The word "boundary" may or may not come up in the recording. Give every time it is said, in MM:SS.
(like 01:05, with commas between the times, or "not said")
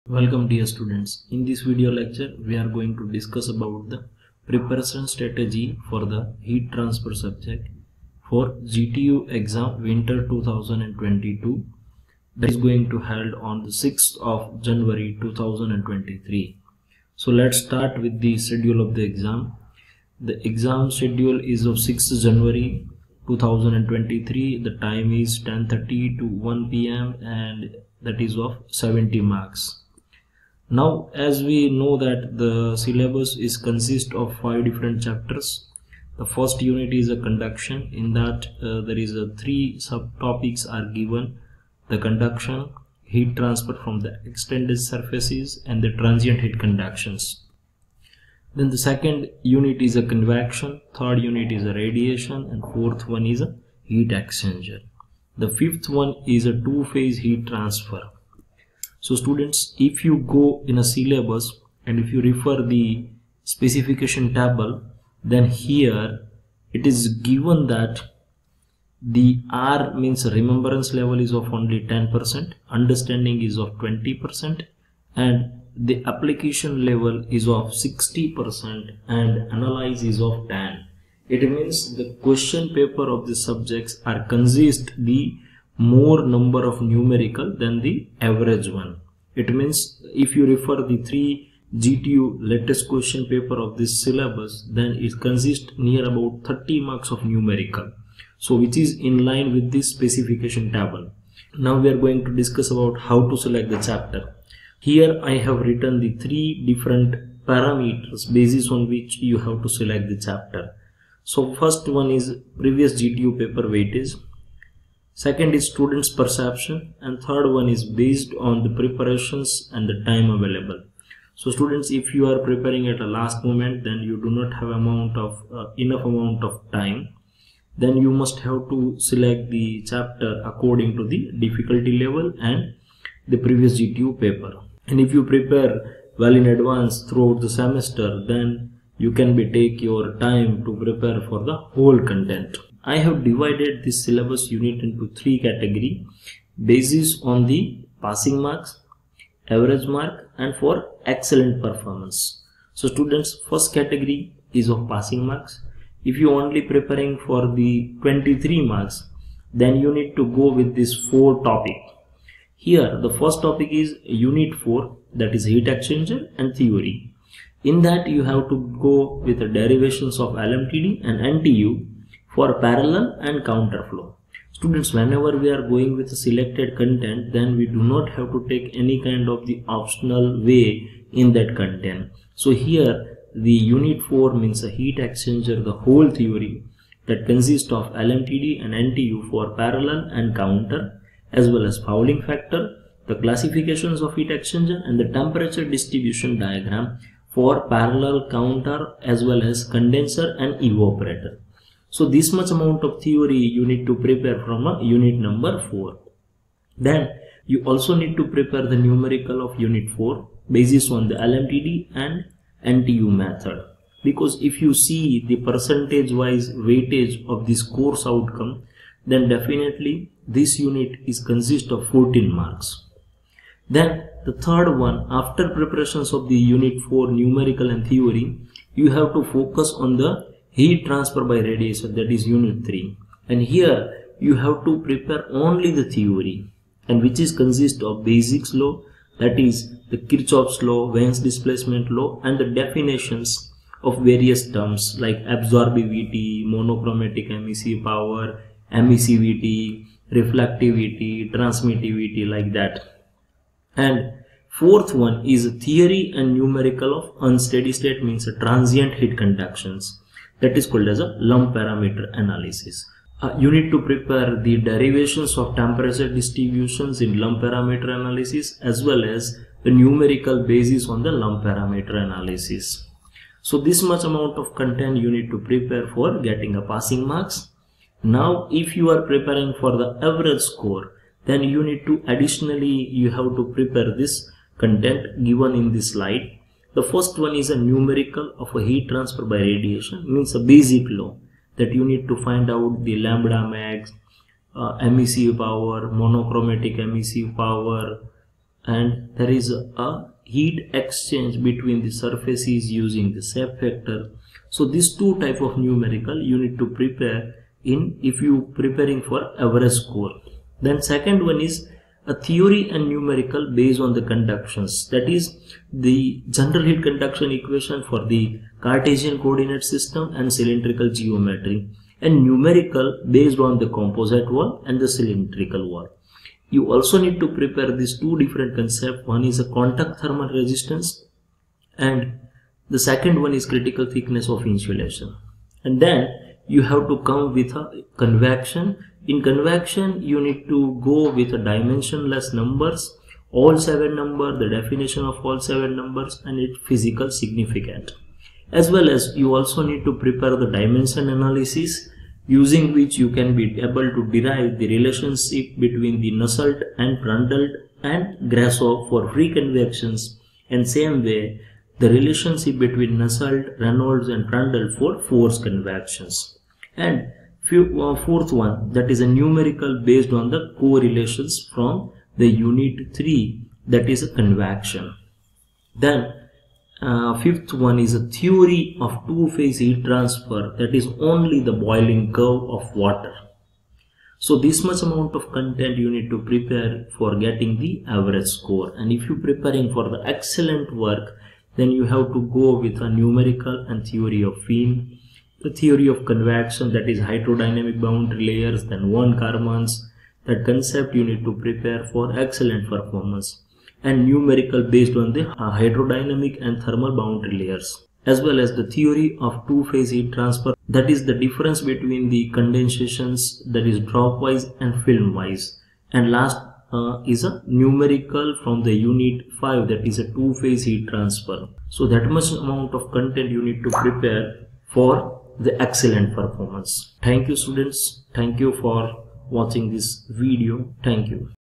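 06:37, 06:46.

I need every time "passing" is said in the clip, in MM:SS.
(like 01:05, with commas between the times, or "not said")
02:28, 02:34, 04:36.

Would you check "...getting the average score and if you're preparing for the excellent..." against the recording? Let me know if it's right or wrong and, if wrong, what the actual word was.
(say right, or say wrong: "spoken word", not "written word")
right.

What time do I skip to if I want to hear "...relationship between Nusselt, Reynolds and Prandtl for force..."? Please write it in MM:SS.
06:01.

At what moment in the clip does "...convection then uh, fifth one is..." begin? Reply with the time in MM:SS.
06:14.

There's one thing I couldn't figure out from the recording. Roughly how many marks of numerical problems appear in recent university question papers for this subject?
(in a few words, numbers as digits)
30 marks.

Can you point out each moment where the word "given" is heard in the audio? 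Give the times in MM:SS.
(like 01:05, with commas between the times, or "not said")
00:40, 01:07, 04:45.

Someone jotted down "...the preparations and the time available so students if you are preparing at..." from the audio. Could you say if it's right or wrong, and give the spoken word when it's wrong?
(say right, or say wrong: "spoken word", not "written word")
right.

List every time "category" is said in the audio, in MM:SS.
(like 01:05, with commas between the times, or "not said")
02:25, 02:33.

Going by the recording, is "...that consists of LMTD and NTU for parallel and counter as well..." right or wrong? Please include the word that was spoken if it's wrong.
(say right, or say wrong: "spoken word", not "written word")
right.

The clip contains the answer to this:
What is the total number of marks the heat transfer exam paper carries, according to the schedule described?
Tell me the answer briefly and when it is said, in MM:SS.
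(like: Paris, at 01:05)
70, at 00:28.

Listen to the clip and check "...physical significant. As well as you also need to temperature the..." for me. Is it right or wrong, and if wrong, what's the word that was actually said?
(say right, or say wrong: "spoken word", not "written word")
wrong: "prepare", not "temperature".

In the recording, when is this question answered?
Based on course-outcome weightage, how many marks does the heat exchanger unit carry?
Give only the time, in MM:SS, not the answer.
03:41.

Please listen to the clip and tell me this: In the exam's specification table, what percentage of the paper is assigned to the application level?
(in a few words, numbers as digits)
60%.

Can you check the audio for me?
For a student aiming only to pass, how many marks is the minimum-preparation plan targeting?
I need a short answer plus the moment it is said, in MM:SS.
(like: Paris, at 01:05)
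23, at 02:38.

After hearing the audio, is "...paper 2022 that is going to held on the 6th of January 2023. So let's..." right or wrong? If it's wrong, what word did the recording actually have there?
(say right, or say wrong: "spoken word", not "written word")
wrong: "winter", not "paper".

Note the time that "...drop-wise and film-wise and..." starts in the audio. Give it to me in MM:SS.
06:53.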